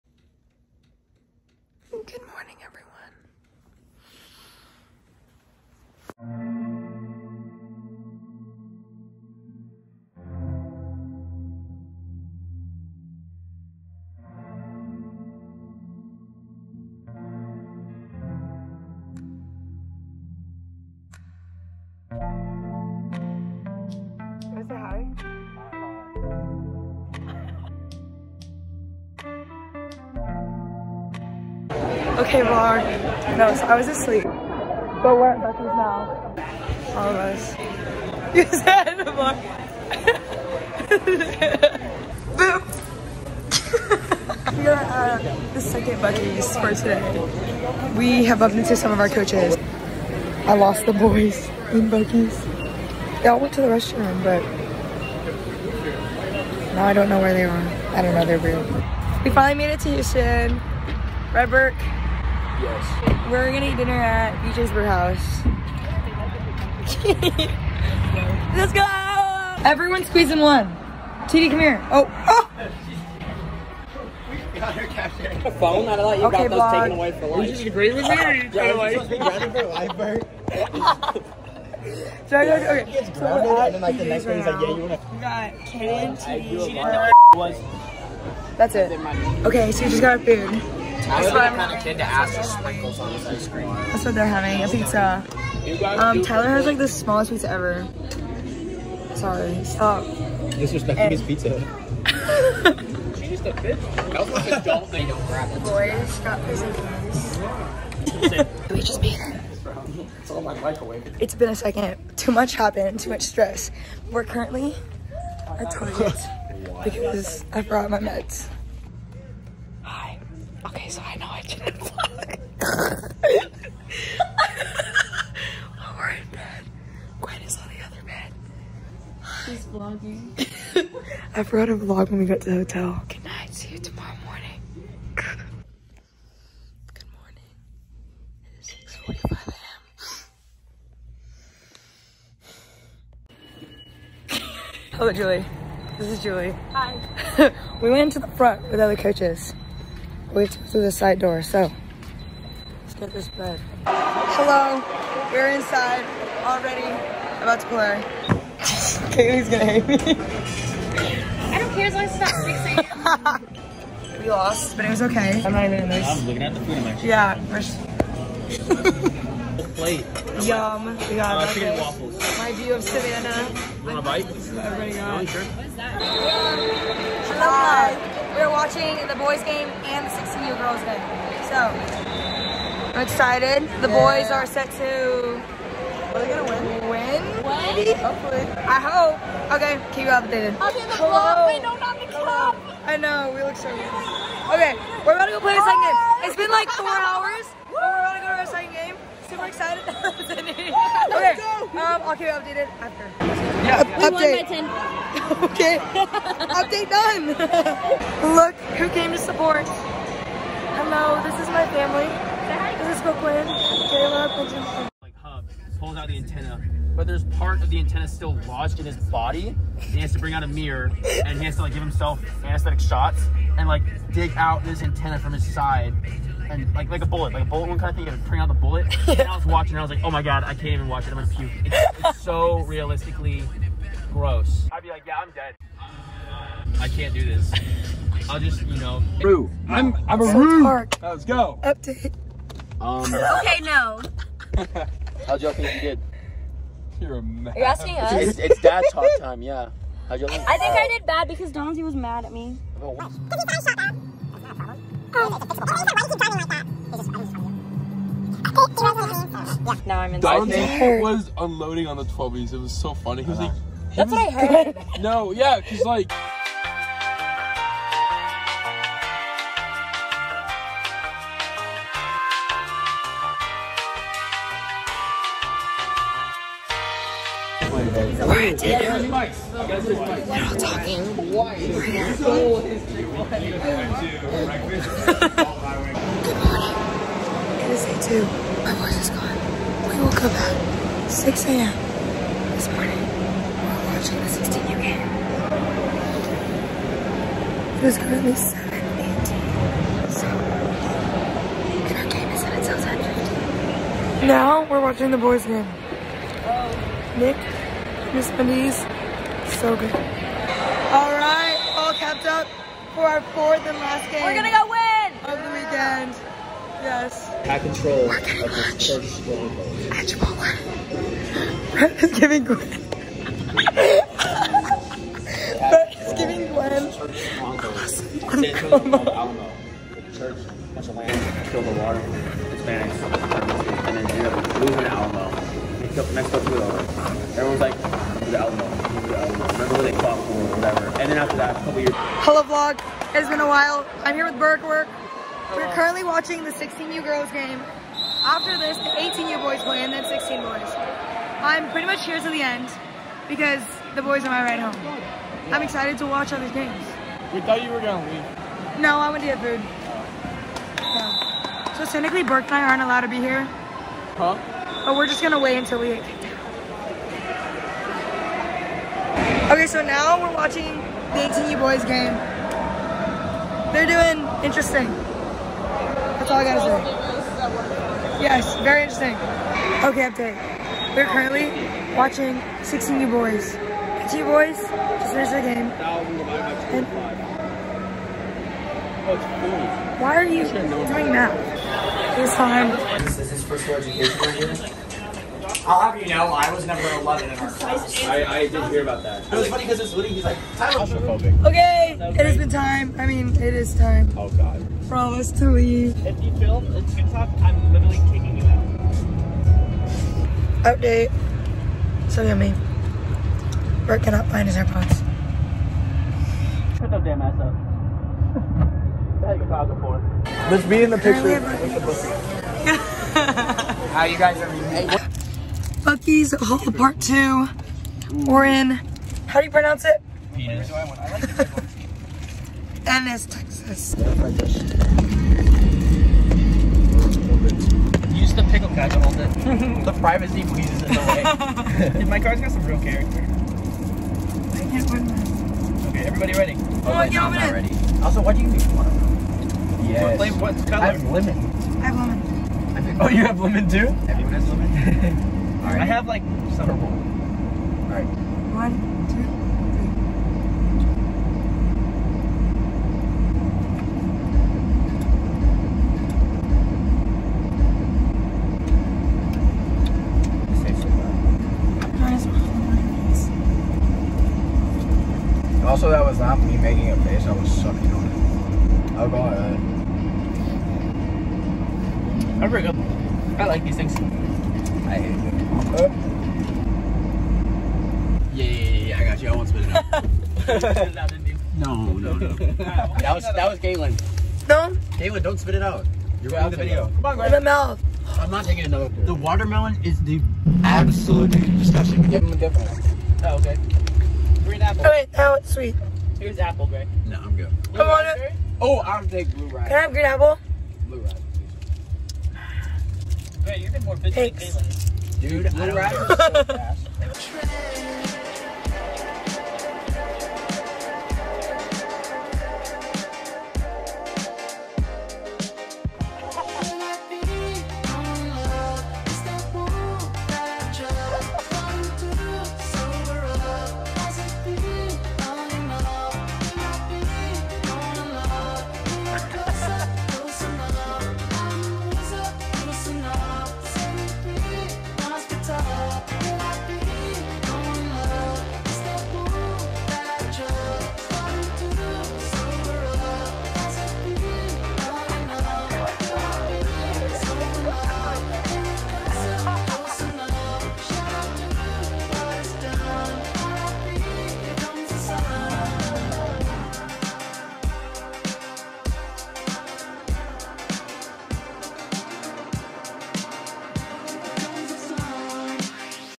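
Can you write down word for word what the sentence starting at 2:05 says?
we're in bed, Gwen is on the other bed.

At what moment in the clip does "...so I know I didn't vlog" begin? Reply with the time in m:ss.
2:00.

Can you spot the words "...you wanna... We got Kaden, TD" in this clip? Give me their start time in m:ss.
1:24.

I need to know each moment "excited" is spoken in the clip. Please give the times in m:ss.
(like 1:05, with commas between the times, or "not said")
3:03, 3:19, 5:55.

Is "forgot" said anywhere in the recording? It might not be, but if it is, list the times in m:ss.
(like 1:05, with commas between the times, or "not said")
2:11.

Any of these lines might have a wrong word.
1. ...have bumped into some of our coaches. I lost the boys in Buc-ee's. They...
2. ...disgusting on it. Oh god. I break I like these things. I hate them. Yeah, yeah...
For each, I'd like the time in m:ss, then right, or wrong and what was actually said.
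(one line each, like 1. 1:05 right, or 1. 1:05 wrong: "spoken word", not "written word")
1. 0:48 right
2. 7:57 wrong: "sucking", not "disgusting".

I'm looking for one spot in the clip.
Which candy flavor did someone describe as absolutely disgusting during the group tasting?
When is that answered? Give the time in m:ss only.
8:19.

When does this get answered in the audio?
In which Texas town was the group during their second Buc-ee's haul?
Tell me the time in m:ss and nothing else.
7:12.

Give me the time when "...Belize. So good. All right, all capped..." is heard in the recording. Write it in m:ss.
5:08.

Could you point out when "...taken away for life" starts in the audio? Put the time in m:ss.
1:16.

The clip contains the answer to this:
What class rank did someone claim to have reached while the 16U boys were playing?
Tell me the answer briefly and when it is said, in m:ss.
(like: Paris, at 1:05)
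11, at 6:36.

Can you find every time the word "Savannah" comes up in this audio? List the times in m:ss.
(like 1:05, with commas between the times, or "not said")
2:52.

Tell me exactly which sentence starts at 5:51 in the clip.
I'm pretty much here to the end because the boys are my ride home.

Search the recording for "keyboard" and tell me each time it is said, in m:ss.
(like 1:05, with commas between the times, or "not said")
not said.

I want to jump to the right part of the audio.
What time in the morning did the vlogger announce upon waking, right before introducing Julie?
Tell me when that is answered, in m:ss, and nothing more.
2:19.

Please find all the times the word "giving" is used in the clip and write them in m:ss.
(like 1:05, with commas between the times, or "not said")
5:22, 5:26.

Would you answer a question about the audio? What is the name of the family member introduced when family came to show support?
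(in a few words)
Brooklyn.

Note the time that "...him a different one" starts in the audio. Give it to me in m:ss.
8:22.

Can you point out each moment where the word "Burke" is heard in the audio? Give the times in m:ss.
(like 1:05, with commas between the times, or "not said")
1:01, 6:02.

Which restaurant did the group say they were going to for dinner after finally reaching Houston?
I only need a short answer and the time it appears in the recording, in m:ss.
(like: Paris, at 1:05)
BJ's Brew House, at 1:04.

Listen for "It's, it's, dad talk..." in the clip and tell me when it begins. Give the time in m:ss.
4:08.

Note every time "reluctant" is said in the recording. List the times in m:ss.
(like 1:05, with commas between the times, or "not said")
not said.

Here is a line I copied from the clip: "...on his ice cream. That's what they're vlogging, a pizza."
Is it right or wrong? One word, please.
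wrong.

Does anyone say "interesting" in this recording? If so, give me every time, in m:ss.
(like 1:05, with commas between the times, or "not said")
6:14, 6:18.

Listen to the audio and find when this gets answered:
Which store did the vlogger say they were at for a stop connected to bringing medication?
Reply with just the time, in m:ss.
1:55.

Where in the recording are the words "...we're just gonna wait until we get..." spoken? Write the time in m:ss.
6:04.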